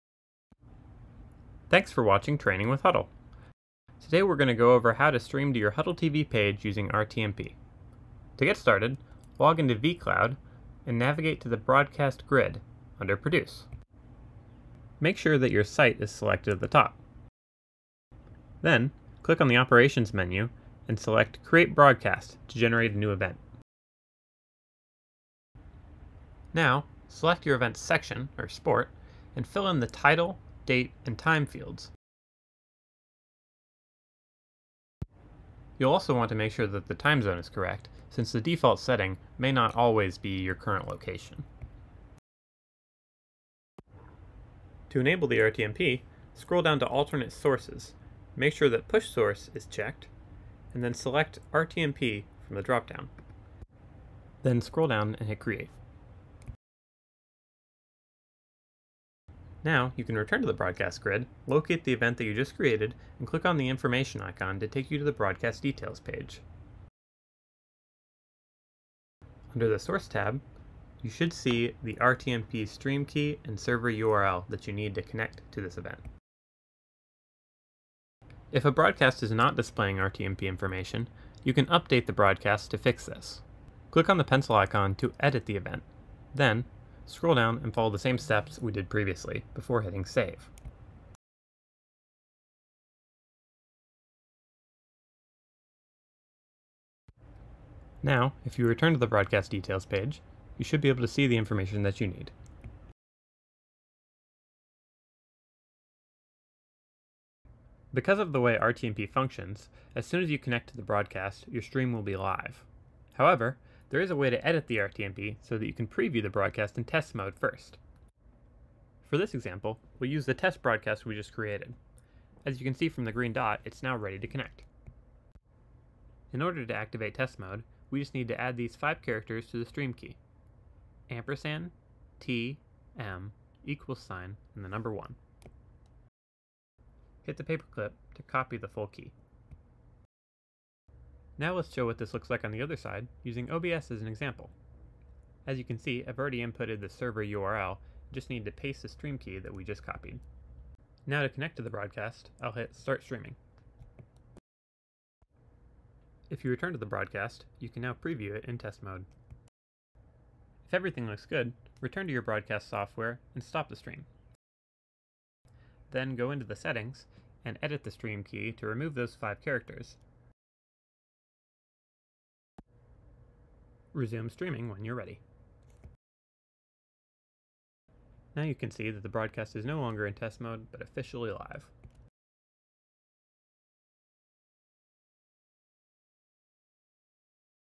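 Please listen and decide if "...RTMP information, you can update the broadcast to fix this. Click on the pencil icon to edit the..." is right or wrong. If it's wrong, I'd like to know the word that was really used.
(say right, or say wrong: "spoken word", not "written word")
right.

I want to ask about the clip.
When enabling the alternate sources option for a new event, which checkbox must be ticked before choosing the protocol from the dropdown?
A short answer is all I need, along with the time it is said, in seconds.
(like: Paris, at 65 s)
Push Source, at 48 s.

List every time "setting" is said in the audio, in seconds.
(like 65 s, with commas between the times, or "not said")
38 s, 166 s.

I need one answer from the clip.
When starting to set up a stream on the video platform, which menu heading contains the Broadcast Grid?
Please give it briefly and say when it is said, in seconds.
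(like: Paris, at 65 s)
Produce, at 13 s.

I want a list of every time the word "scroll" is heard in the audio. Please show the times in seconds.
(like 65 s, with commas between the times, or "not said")
46 s, 54 s, 87 s.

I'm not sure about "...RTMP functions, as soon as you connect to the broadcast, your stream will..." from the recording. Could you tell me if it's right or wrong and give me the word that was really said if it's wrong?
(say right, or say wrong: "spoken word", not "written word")
right.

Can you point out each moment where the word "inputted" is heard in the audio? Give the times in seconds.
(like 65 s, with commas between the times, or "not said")
146 s.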